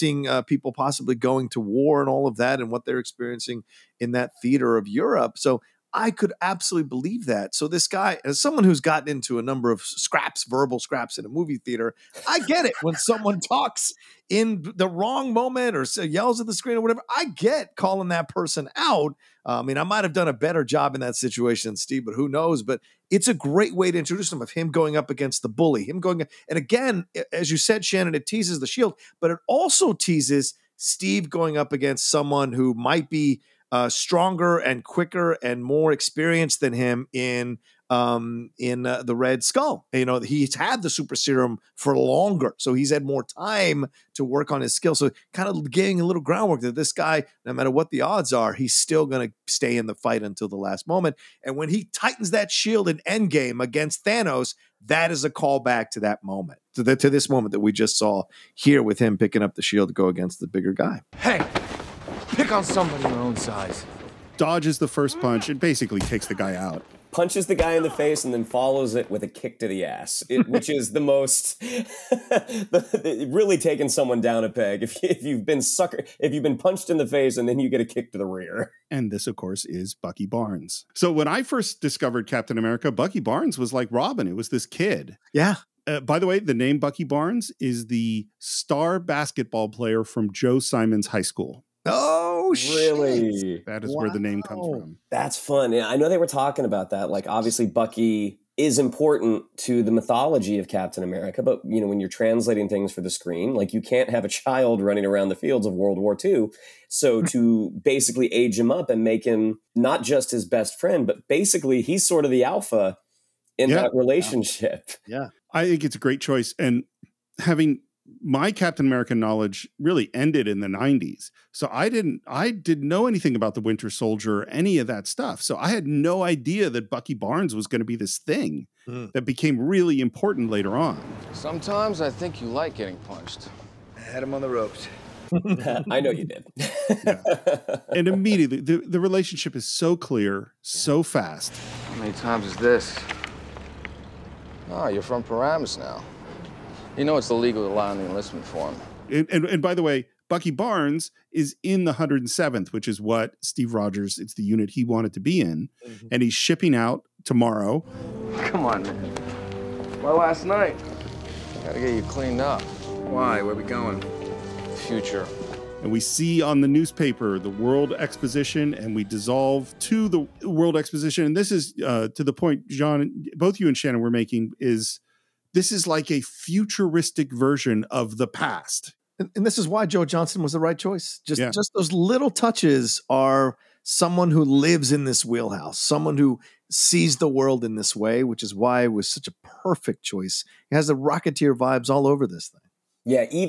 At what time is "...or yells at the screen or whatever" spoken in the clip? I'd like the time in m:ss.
0:15.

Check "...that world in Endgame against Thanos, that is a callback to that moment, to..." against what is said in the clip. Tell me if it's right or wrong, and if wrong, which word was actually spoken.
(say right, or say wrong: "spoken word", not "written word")
wrong: "shield", not "world".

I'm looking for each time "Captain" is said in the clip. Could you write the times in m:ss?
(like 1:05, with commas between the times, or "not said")
1:22, 1:40, 1:58.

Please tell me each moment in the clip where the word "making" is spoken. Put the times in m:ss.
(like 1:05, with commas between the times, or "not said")
2:54.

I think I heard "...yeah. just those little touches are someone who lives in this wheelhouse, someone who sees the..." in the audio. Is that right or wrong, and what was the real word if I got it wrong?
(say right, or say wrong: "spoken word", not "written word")
right.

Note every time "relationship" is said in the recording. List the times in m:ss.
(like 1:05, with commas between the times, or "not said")
1:53, 2:18.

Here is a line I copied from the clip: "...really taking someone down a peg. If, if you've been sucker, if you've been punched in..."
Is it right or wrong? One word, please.
right.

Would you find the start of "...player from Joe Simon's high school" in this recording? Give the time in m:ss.
1:29.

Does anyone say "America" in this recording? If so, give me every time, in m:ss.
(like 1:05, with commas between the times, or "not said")
1:22, 1:41, 1:58.